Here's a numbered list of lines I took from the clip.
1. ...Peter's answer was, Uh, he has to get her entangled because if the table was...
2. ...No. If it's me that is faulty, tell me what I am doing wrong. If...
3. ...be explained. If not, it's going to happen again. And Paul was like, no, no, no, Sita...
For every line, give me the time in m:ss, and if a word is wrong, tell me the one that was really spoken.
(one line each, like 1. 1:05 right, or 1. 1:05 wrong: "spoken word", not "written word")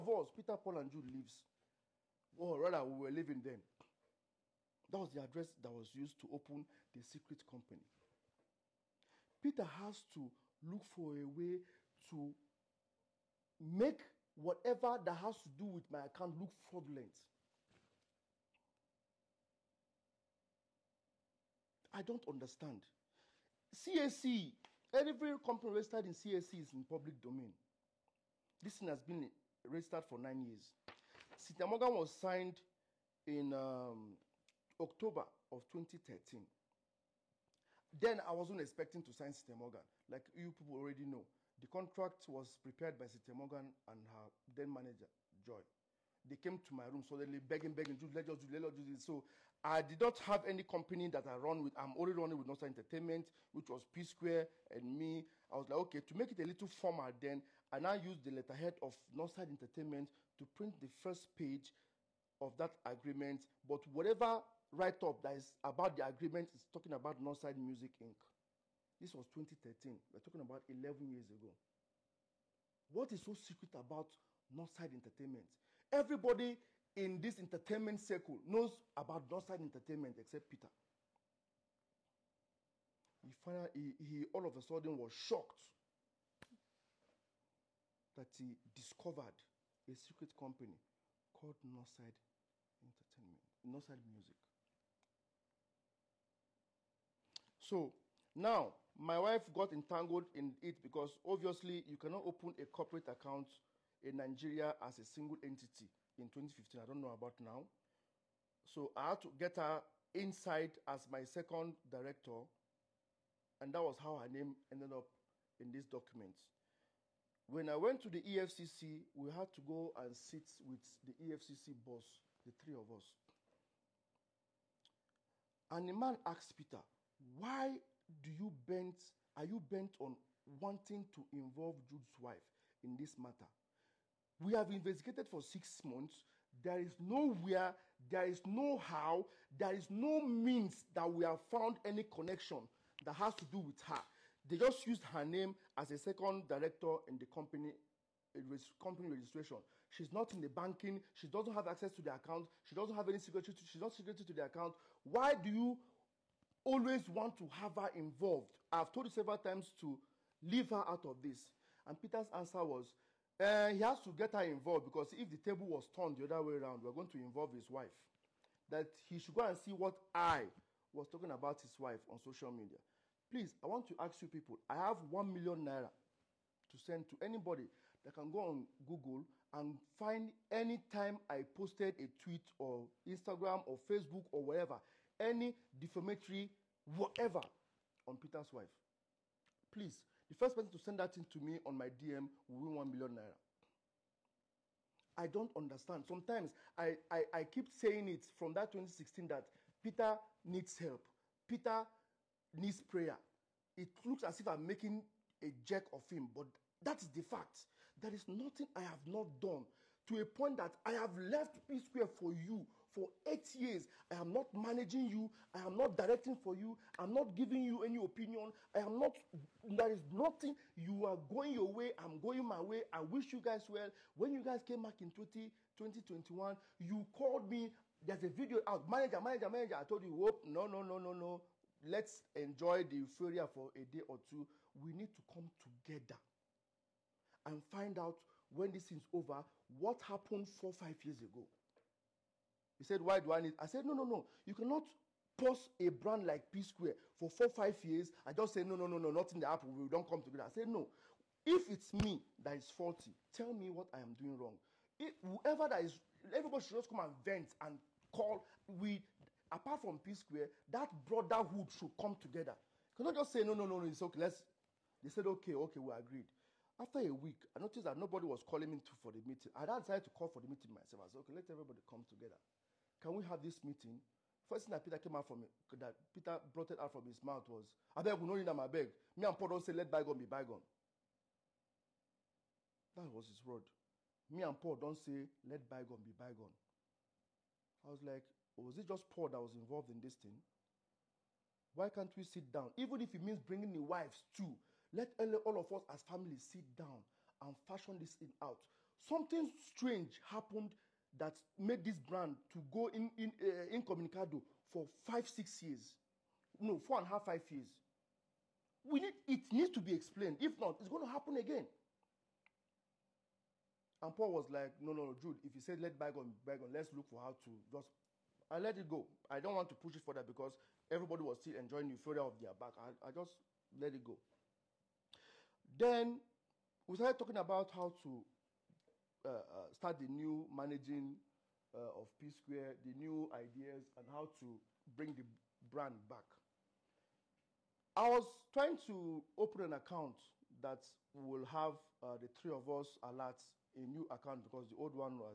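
1. 2:41 wrong: "involved", not "entangled"
2. 4:10 right
3. 5:09 wrong: "Jude", not "Sita".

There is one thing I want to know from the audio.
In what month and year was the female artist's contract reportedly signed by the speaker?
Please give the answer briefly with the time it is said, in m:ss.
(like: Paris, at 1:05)
October 2013, at 0:34.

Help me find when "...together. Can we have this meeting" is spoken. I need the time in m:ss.
4:32.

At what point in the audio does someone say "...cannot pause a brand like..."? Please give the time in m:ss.
4:04.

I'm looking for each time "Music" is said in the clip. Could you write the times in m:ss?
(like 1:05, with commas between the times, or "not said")
1:07, 1:34.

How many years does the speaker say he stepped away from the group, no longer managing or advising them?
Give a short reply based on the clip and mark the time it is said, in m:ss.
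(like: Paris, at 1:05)
8, at 3:33.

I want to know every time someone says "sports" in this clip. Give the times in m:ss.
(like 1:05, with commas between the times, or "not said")
not said.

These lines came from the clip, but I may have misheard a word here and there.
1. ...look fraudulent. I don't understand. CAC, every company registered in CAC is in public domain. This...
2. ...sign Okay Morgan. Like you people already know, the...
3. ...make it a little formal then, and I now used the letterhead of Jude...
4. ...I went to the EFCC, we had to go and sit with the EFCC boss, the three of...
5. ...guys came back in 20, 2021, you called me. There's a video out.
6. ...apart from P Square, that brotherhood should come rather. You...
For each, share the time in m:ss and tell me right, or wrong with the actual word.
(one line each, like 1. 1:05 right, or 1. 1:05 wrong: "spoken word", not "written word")
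1. 0:16 right
2. 0:39 wrong: "Sita", not "Okay"
3. 0:56 wrong: "Nostra", not "Jude"
4. 1:57 right
5. 3:44 right
6. 4:19 wrong: "together", not "rather".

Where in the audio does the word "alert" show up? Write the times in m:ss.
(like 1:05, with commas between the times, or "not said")
5:43.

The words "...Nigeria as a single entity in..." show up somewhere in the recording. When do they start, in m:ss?
1:44.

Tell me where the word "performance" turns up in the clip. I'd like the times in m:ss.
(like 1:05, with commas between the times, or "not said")
not said.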